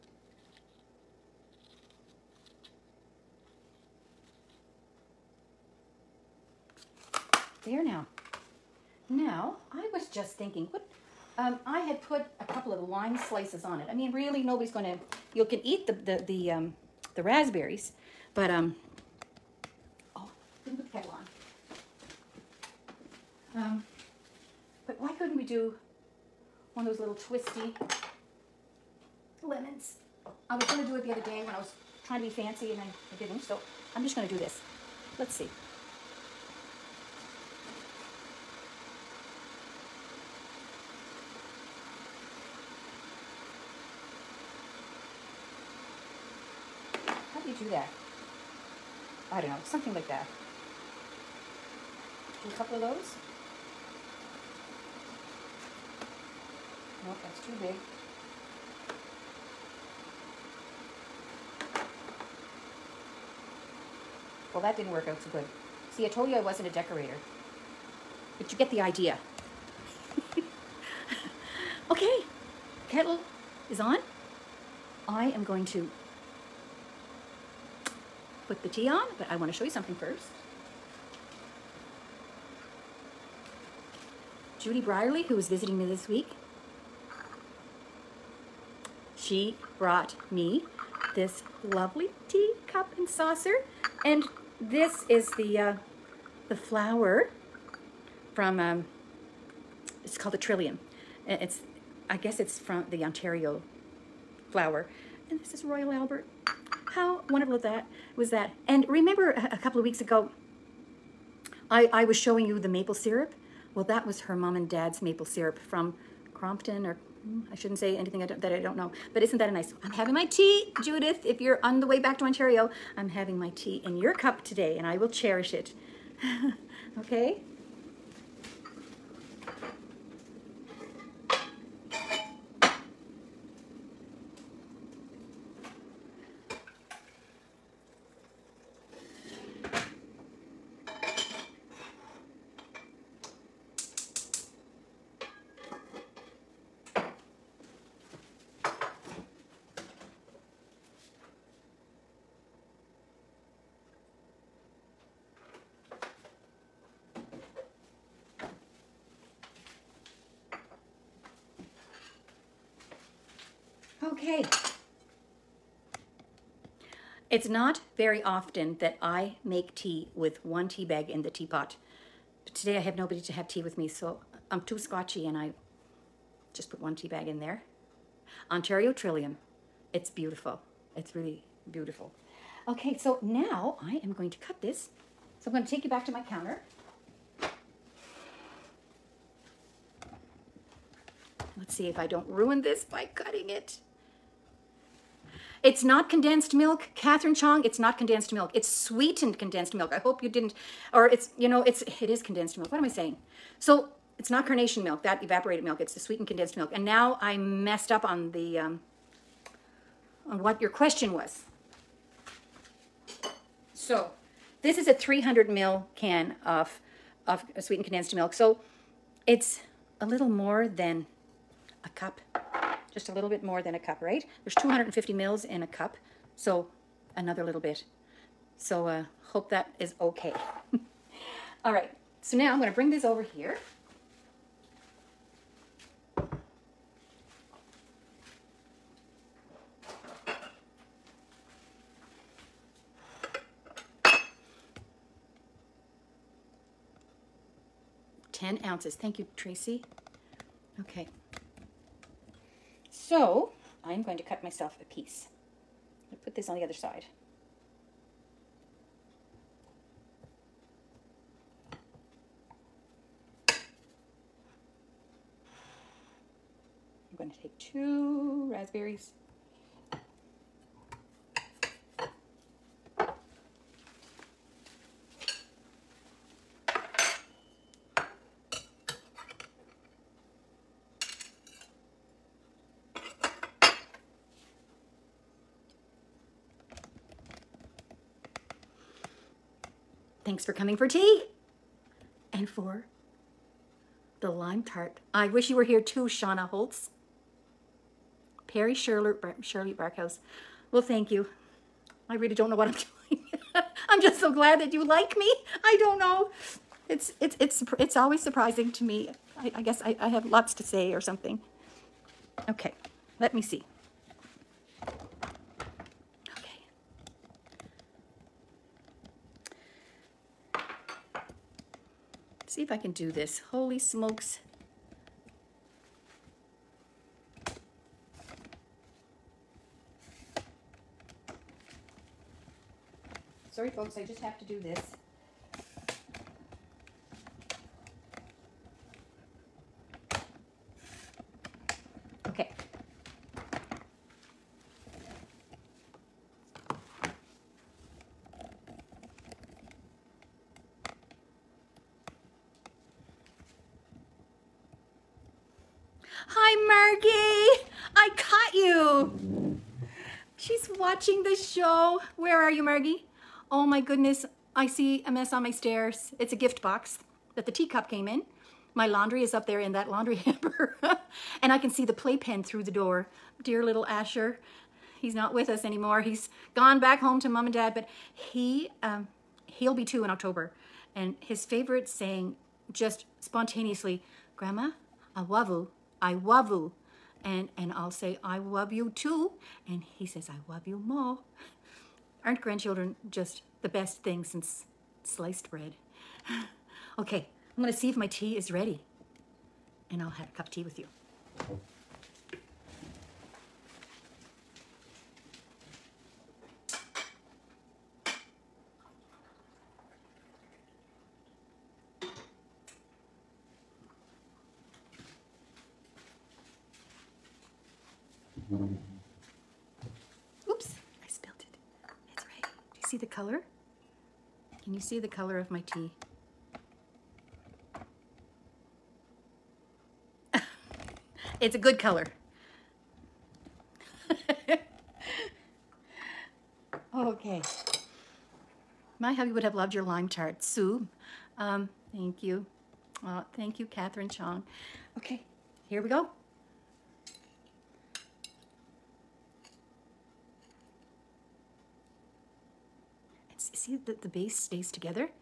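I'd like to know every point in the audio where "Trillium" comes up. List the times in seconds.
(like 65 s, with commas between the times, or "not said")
100 s, 178 s.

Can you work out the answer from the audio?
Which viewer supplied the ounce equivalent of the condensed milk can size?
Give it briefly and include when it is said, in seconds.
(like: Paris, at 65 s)
Tracy, at 249 s.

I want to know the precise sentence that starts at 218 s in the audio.
So it's a little more than a cup, just a little bit more than a cup, right?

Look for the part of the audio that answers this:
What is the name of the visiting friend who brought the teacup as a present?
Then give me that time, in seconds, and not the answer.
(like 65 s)
84 s.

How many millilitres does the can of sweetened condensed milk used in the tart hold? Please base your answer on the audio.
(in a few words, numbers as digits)
300 ml.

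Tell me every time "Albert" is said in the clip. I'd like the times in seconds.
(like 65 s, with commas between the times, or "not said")
105 s.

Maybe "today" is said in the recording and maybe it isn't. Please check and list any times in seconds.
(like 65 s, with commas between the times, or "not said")
124 s, 172 s.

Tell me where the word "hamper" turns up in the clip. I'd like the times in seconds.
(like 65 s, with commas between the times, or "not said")
370 s.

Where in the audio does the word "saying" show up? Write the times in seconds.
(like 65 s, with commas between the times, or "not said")
202 s, 381 s.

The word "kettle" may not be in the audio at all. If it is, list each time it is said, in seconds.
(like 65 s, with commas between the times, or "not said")
20 s, 72 s.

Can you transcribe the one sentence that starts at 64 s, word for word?
Well, that didn't work out so good.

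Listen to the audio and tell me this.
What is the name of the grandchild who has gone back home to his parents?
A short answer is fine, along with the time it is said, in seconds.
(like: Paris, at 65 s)
Asher, at 373 s.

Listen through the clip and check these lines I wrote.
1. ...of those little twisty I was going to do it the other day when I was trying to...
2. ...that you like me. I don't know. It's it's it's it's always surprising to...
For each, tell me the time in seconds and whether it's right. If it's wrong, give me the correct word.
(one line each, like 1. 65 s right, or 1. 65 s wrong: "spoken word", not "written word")
1. 26 s right
2. 304 s right.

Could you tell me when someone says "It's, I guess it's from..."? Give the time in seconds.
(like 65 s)
101 s.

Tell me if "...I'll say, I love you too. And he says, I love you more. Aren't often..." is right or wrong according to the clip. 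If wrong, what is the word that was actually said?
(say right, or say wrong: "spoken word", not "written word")
wrong: "grandchildren", not "often".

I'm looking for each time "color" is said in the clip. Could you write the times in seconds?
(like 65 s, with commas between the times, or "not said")
425 s, 431 s.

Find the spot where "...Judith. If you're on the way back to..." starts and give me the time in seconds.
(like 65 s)
120 s.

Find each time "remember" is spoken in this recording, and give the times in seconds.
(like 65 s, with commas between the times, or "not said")
108 s.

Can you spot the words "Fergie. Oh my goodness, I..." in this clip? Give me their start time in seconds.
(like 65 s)
362 s.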